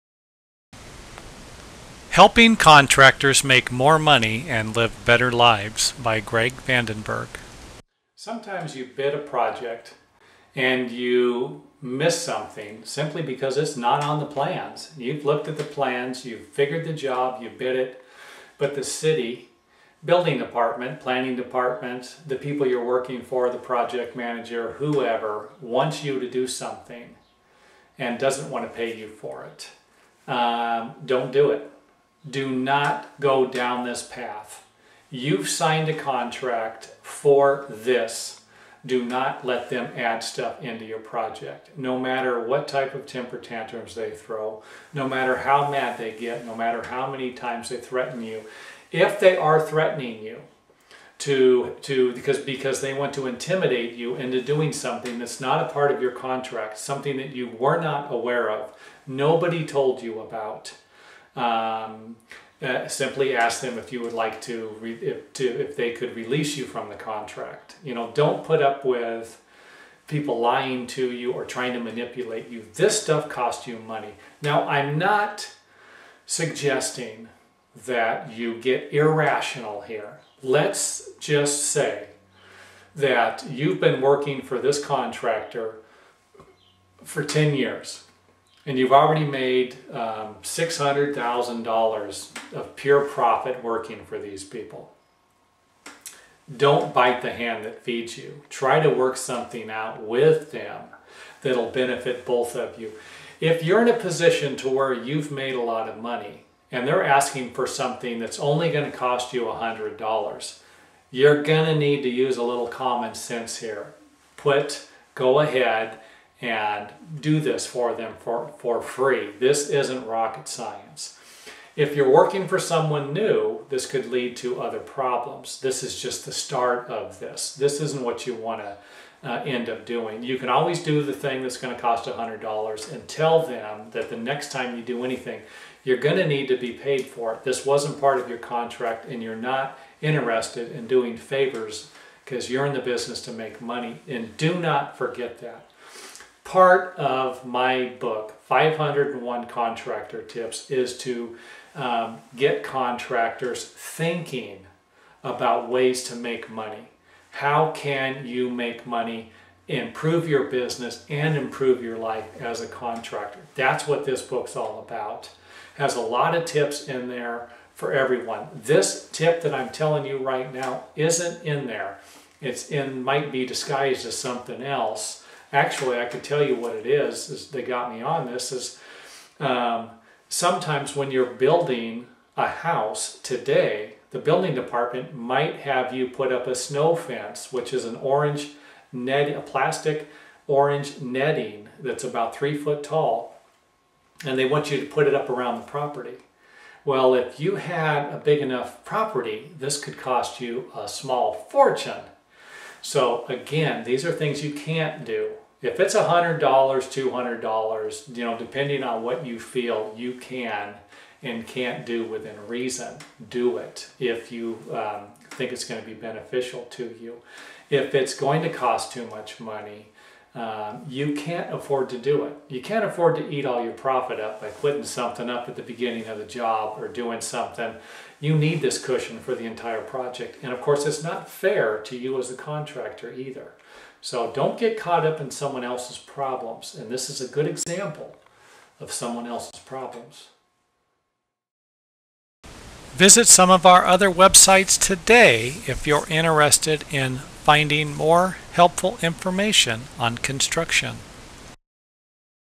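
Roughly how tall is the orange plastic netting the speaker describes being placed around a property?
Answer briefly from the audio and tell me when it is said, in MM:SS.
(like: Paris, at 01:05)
3 feet, at 03:12.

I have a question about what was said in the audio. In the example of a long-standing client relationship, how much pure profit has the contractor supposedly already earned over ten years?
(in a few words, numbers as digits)
$600,000.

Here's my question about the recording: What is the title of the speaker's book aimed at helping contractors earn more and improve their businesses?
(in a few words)
501 Contractor Tips.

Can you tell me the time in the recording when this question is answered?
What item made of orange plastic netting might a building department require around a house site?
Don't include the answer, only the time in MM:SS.
03:06.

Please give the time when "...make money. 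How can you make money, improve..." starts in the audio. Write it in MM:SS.
02:36.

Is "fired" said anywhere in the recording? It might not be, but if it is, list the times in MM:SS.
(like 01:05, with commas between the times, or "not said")
not said.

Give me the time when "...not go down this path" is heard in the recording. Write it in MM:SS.
00:32.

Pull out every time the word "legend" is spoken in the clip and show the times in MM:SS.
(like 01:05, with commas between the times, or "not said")
not said.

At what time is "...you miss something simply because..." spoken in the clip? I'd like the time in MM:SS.
00:10.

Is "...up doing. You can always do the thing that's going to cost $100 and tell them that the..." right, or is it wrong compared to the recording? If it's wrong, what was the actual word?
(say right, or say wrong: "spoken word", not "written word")
right.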